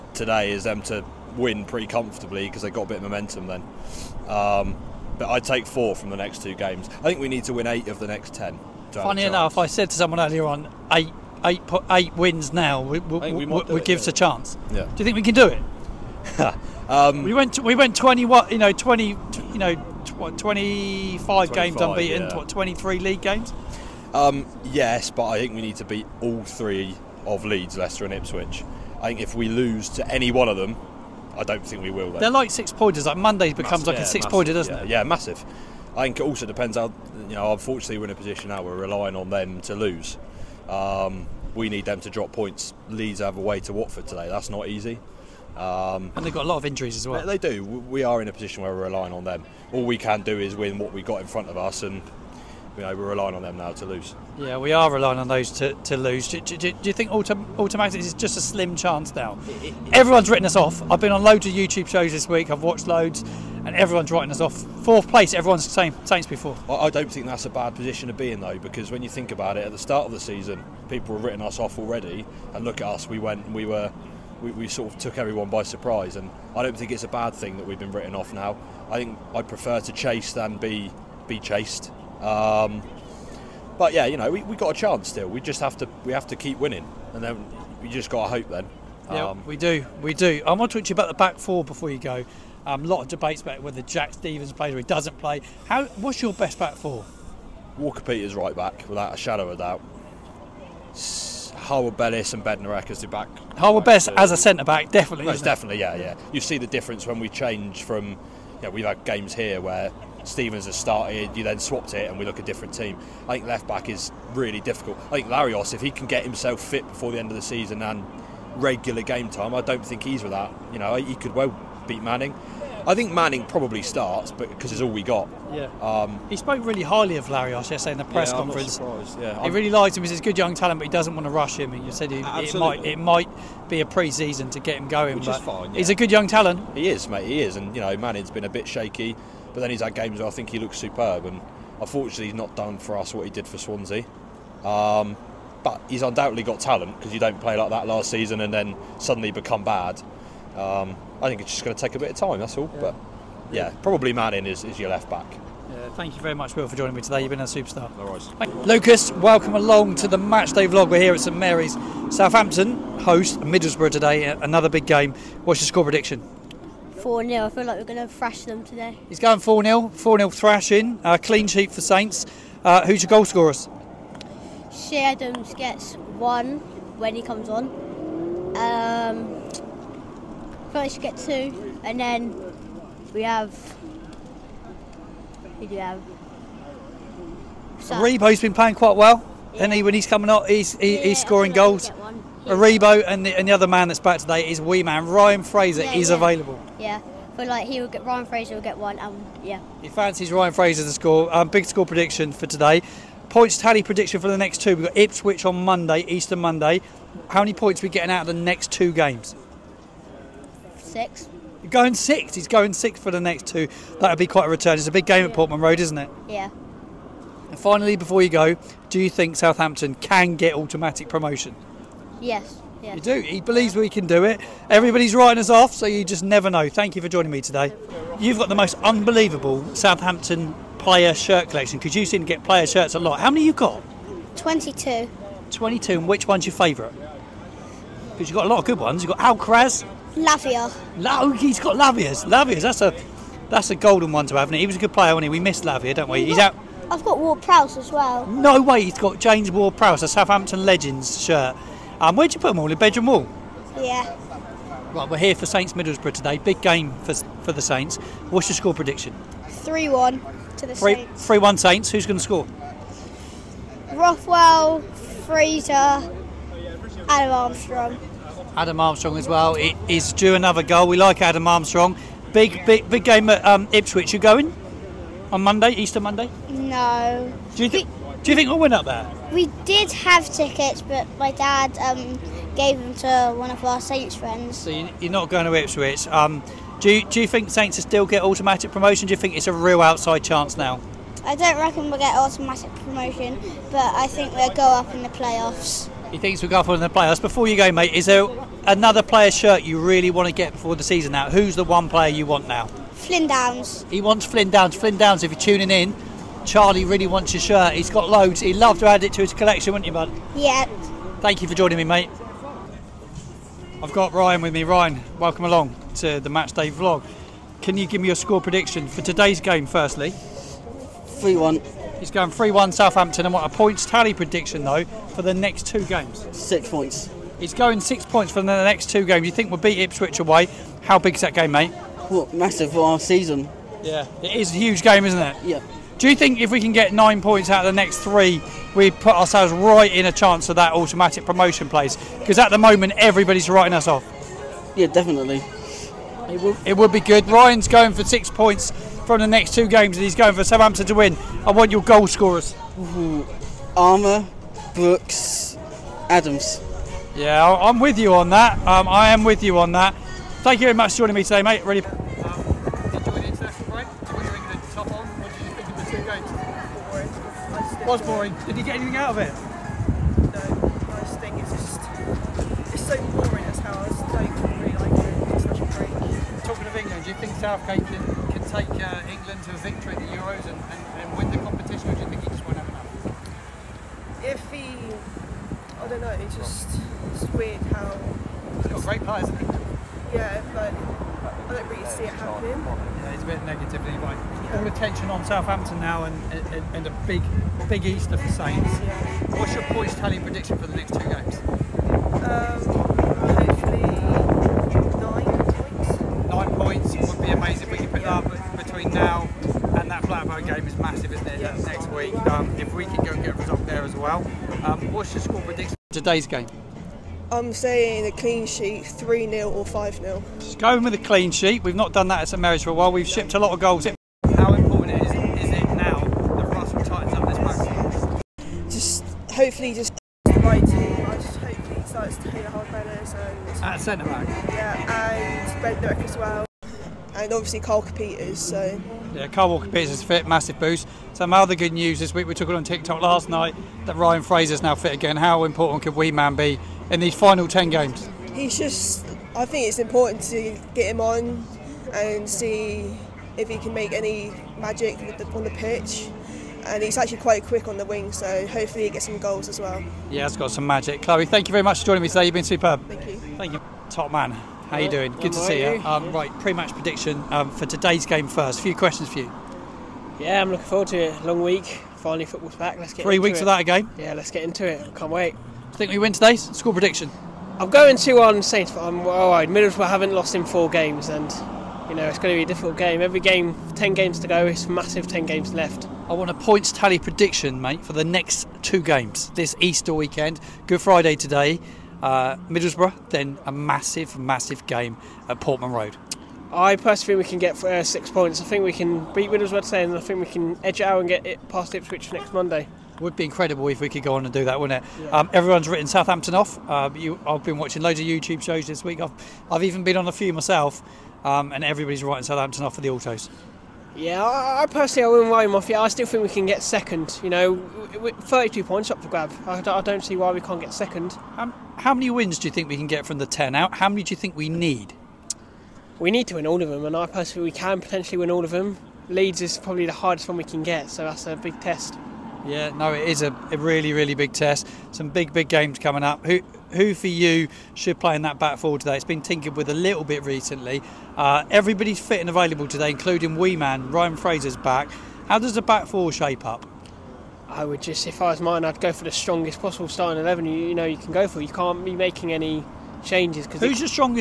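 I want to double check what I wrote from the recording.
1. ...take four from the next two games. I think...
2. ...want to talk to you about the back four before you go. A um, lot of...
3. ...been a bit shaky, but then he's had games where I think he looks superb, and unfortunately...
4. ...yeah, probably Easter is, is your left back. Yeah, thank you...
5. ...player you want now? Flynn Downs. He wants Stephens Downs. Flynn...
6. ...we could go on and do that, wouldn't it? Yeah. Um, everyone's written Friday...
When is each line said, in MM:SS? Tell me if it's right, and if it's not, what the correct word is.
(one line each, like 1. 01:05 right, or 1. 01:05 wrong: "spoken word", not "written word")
1. 00:05 right
2. 01:30 right
3. 02:18 right
4. 02:33 wrong: "Manning", not "Easter"
5. 05:01 wrong: "Flynn", not "Stephens"
6. 08:23 wrong: "Southampton", not "Friday".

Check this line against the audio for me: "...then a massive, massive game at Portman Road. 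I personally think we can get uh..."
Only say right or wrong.
right.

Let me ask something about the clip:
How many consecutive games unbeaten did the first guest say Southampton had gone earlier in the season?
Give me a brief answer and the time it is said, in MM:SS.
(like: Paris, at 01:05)
25, at 00:20.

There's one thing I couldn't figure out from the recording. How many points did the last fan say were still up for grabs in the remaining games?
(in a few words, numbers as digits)
32.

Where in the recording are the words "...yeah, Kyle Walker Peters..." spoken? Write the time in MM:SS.
07:19.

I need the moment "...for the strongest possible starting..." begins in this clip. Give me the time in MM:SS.
09:08.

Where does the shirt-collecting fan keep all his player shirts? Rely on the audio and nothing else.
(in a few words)
Bedroom wall.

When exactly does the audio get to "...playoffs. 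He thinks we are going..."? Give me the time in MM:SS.
04:55.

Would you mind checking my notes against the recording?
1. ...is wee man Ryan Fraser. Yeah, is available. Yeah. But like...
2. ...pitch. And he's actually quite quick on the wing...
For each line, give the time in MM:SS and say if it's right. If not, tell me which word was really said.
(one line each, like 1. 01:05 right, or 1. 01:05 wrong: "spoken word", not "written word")
1. 03:14 right
2. 07:35 right.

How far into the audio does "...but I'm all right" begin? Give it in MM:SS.
07:58.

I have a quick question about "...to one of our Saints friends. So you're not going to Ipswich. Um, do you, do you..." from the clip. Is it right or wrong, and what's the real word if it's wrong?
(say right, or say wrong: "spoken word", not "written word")
right.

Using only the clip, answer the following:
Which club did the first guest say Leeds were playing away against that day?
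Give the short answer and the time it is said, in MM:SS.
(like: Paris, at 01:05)
Watford, at 00:43.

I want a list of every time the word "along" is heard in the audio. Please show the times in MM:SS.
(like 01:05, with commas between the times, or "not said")
02:39, 05:15.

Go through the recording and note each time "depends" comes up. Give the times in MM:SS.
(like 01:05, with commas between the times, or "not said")
00:36.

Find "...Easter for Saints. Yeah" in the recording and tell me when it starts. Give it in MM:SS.
06:37.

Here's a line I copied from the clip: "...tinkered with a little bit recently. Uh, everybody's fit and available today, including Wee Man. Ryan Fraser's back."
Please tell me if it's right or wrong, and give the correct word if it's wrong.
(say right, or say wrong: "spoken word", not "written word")
right.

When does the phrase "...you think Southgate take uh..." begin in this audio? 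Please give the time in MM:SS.
06:17.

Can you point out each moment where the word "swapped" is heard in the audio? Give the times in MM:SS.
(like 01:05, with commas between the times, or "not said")
01:51.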